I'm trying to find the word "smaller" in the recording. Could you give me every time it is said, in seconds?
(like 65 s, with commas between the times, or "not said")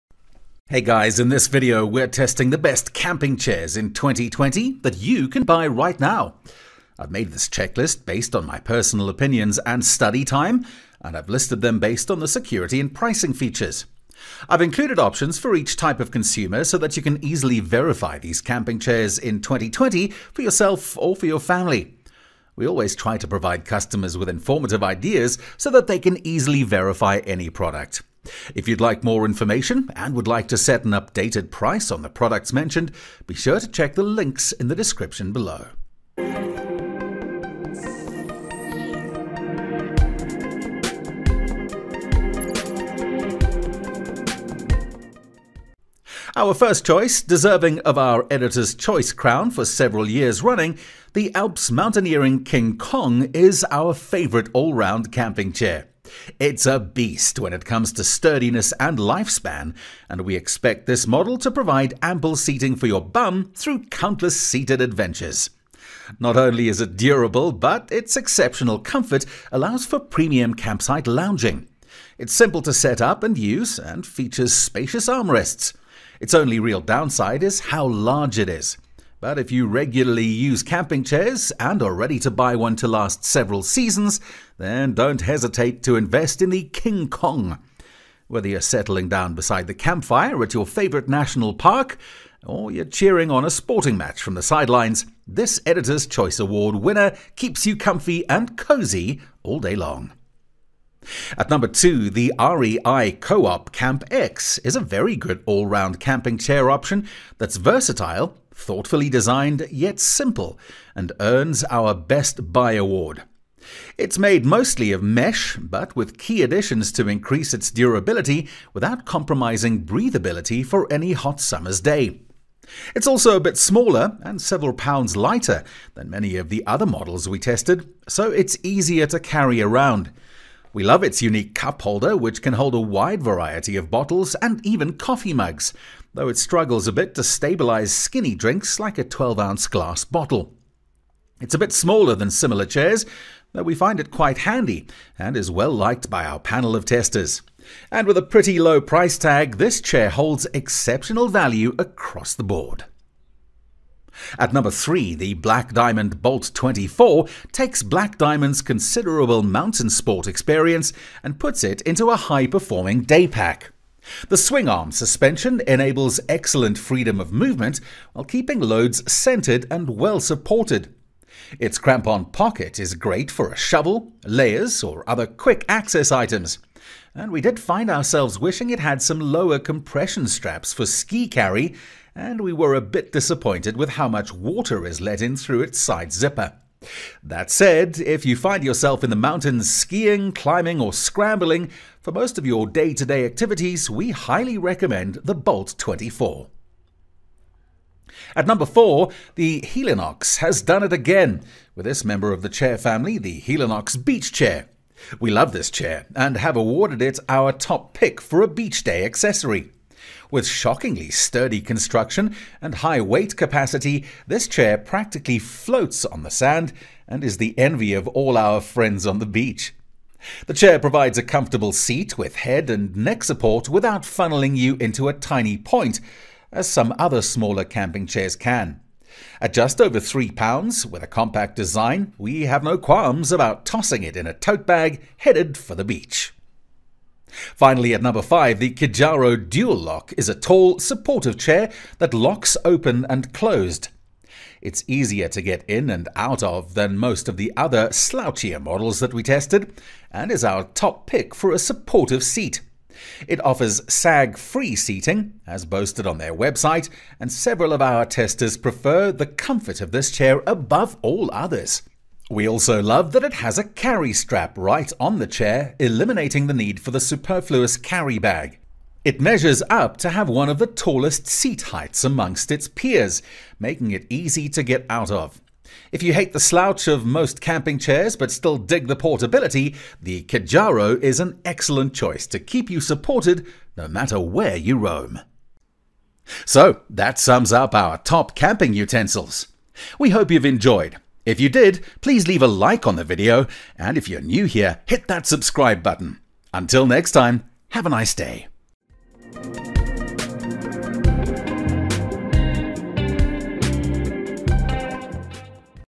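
123 s, 141 s, 227 s.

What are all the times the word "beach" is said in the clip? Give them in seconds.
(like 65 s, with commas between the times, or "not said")
204 s, 208 s, 219 s, 235 s.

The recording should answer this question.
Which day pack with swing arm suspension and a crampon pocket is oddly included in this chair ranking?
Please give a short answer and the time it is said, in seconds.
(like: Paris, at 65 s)
Black Diamond Bolt 24, at 155 s.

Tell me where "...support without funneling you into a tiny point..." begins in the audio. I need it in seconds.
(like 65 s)
223 s.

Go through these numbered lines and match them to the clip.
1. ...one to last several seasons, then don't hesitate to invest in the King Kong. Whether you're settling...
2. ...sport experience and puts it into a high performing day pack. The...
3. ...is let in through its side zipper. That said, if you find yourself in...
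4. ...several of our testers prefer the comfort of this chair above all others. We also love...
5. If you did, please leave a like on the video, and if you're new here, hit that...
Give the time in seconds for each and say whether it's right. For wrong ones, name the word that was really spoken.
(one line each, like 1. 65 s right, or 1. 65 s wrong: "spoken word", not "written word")
1. 82 s right
2. 159 s right
3. 184 s right
4. 257 s right
5. 291 s right.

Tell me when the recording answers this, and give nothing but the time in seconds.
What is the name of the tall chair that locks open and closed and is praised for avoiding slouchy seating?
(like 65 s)
238 s.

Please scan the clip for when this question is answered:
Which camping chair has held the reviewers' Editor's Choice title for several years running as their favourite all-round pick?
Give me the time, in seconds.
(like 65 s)
51 s.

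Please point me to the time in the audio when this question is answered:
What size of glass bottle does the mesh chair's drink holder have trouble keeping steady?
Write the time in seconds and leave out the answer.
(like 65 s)
139 s.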